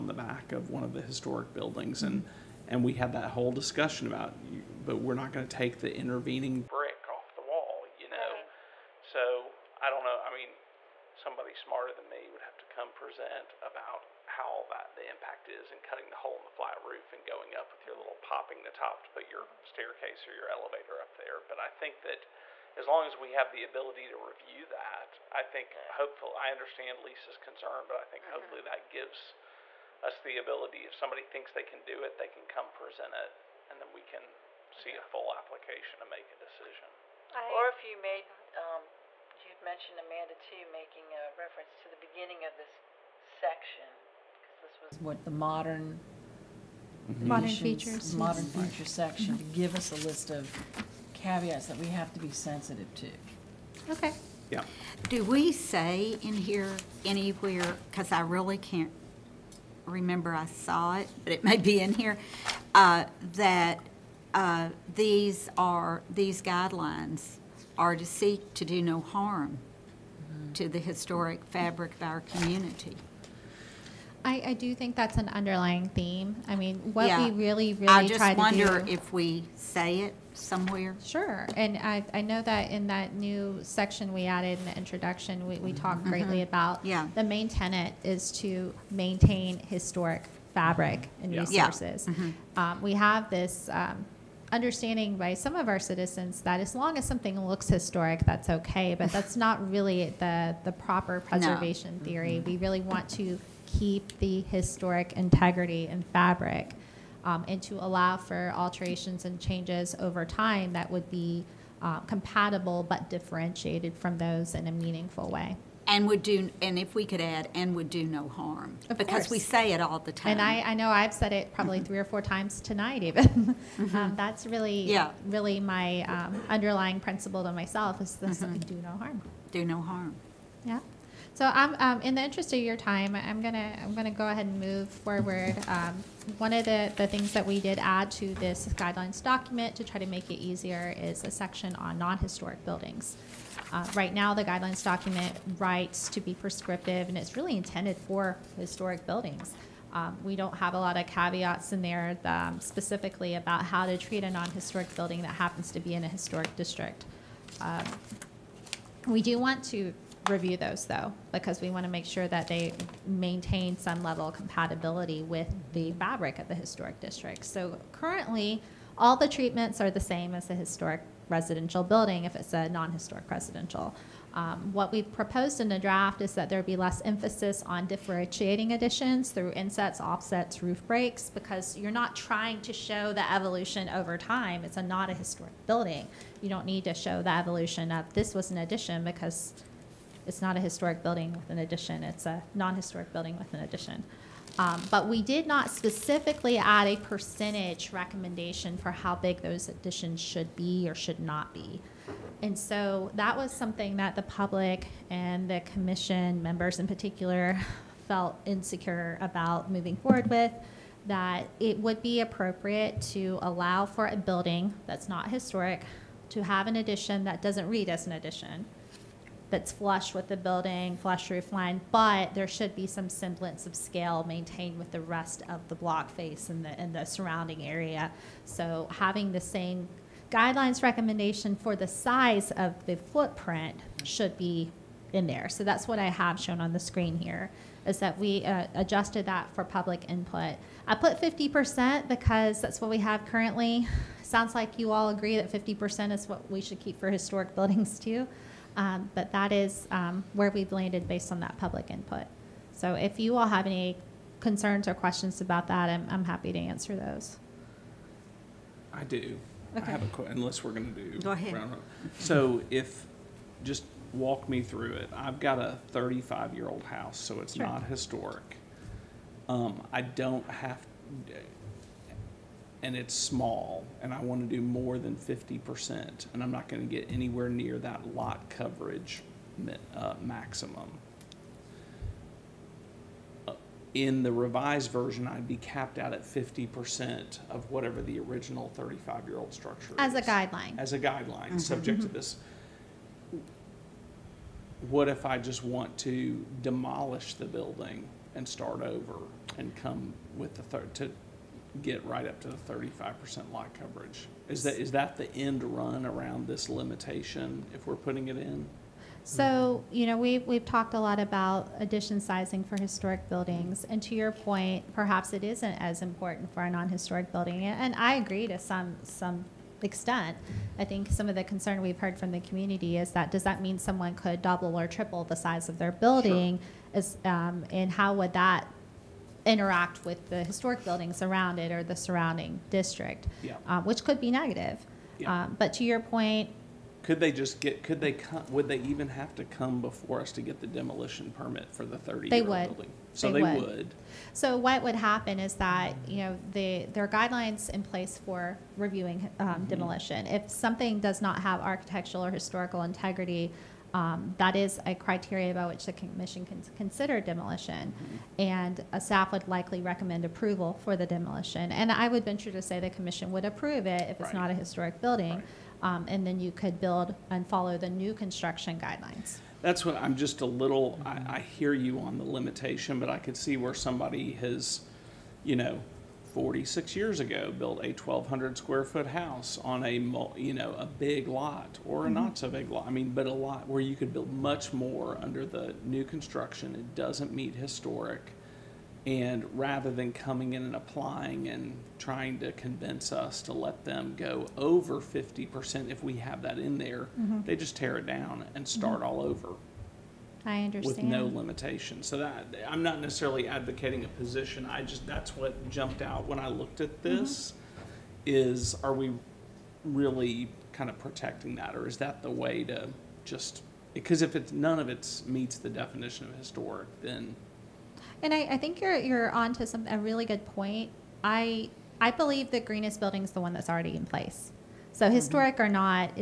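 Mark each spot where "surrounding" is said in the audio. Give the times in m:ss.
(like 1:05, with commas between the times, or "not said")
3:47, 5:31.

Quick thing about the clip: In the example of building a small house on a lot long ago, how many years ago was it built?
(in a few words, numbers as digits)
46.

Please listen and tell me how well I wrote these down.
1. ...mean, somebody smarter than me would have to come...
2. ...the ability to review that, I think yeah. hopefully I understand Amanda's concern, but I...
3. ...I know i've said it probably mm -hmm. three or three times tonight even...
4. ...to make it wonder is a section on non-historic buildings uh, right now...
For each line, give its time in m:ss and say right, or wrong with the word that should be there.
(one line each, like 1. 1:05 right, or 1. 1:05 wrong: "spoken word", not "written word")
1. 0:10 right
2. 0:23 wrong: "Lisa", not "Amanda"
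3. 2:00 wrong: "four", not "three"
4. 2:20 wrong: "easier", not "wonder".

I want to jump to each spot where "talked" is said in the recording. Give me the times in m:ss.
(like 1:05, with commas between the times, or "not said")
1:25, 5:10.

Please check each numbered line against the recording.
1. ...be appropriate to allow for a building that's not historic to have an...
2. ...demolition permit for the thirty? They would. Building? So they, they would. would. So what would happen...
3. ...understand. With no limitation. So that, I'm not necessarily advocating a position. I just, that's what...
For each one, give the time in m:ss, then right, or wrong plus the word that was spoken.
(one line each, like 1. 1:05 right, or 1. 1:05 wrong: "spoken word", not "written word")
1. 3:32 right
2. 5:40 right
3. 6:40 right.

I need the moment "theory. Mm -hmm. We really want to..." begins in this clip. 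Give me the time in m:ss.
1:42.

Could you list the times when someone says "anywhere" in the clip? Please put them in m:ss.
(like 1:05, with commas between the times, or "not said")
0:57, 4:37.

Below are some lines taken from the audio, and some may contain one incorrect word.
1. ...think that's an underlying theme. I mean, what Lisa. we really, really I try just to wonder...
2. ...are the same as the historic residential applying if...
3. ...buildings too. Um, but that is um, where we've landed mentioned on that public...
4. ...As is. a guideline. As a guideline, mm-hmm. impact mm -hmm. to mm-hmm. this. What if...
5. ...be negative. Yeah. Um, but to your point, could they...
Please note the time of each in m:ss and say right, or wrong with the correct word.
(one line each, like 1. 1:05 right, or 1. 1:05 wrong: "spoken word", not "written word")
1. 1:14 wrong: "Yeah", not "Lisa"
2. 2:49 wrong: "building", not "applying"
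3. 4:07 wrong: "based", not "mentioned"
4. 4:49 wrong: "subject", not "impact"
5. 5:34 right.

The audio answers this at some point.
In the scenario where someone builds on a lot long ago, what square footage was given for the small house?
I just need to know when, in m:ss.
6:17.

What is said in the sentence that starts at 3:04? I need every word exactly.
It's a, not a historic building.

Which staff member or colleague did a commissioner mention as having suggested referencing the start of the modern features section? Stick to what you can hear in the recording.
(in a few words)
Amanda.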